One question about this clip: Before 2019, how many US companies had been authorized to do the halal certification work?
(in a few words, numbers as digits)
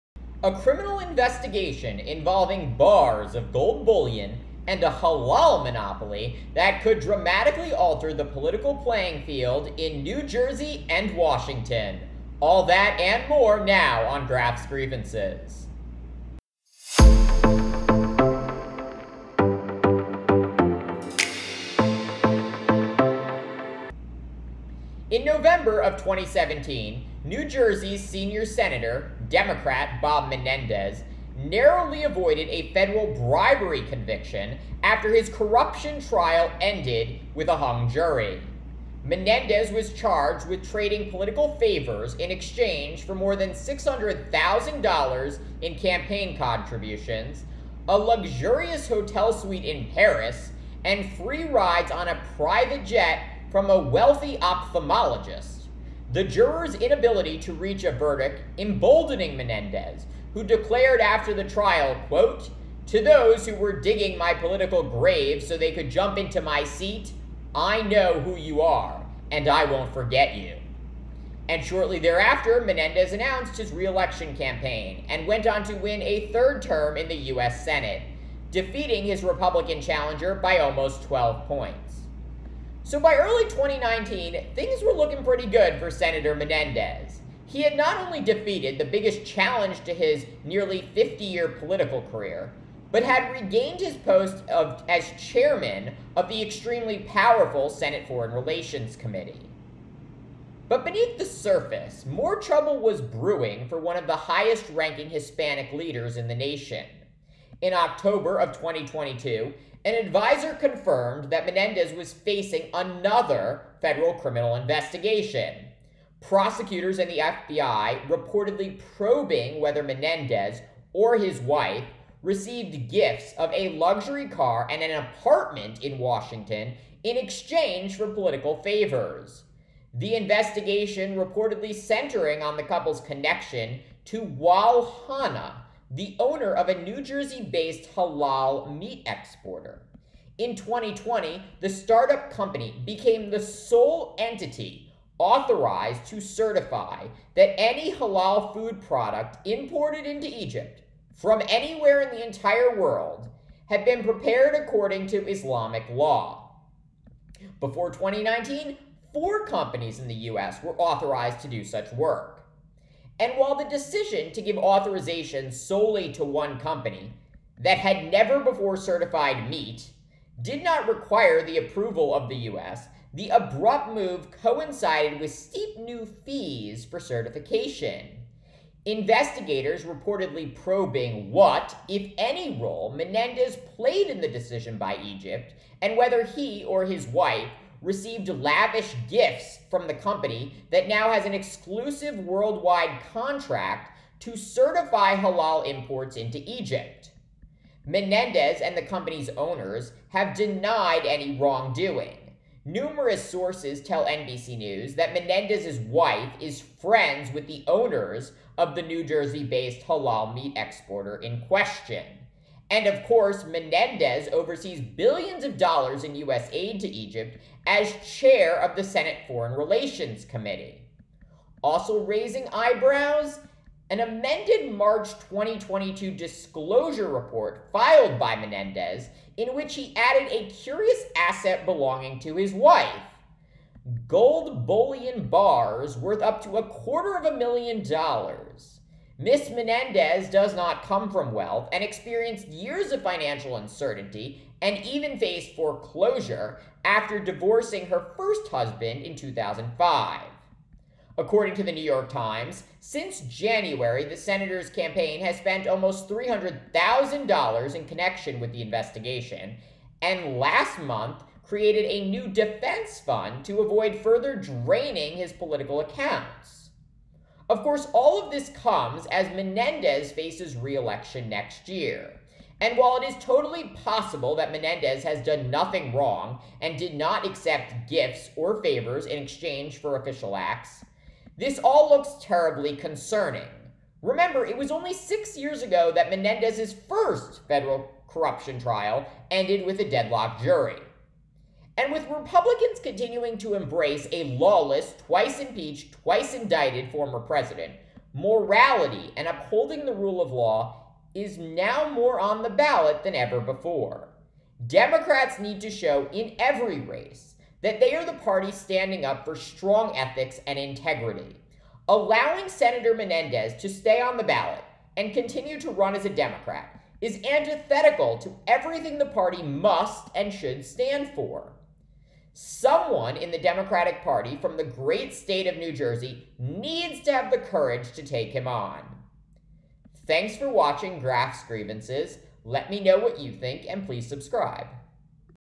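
4.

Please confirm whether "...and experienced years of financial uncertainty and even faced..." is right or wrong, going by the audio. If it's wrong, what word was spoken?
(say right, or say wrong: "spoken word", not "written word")
right.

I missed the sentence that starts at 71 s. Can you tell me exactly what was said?
And shortly thereafter, Menendez announced his reelection campaign and went on to win a third term in the U.S.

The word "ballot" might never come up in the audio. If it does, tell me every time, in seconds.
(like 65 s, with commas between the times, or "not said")
302 s, 314 s.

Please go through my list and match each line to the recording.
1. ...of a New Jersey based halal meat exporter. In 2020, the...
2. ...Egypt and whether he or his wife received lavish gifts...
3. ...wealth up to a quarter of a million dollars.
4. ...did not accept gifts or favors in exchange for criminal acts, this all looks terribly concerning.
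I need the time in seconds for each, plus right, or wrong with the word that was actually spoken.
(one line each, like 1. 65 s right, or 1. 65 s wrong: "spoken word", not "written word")
1. 136 s right
2. 185 s right
3. 235 s wrong: "worth", not "wealth"
4. 276 s wrong: "official", not "criminal".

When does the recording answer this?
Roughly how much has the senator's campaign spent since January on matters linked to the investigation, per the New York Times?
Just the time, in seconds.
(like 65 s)
255 s.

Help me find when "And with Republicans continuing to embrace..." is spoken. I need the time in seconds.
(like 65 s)
291 s.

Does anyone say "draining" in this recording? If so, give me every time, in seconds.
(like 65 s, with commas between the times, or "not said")
264 s.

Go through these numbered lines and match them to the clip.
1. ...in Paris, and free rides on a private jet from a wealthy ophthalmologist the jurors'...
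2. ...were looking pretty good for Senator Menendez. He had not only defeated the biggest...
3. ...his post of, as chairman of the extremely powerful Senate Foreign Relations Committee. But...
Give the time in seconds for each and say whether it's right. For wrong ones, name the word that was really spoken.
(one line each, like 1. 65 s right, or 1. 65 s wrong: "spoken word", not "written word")
1. 49 s right
2. 84 s right
3. 93 s right.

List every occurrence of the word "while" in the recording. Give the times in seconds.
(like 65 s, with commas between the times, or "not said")
163 s, 272 s.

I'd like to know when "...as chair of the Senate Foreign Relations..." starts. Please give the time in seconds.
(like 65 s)
217 s.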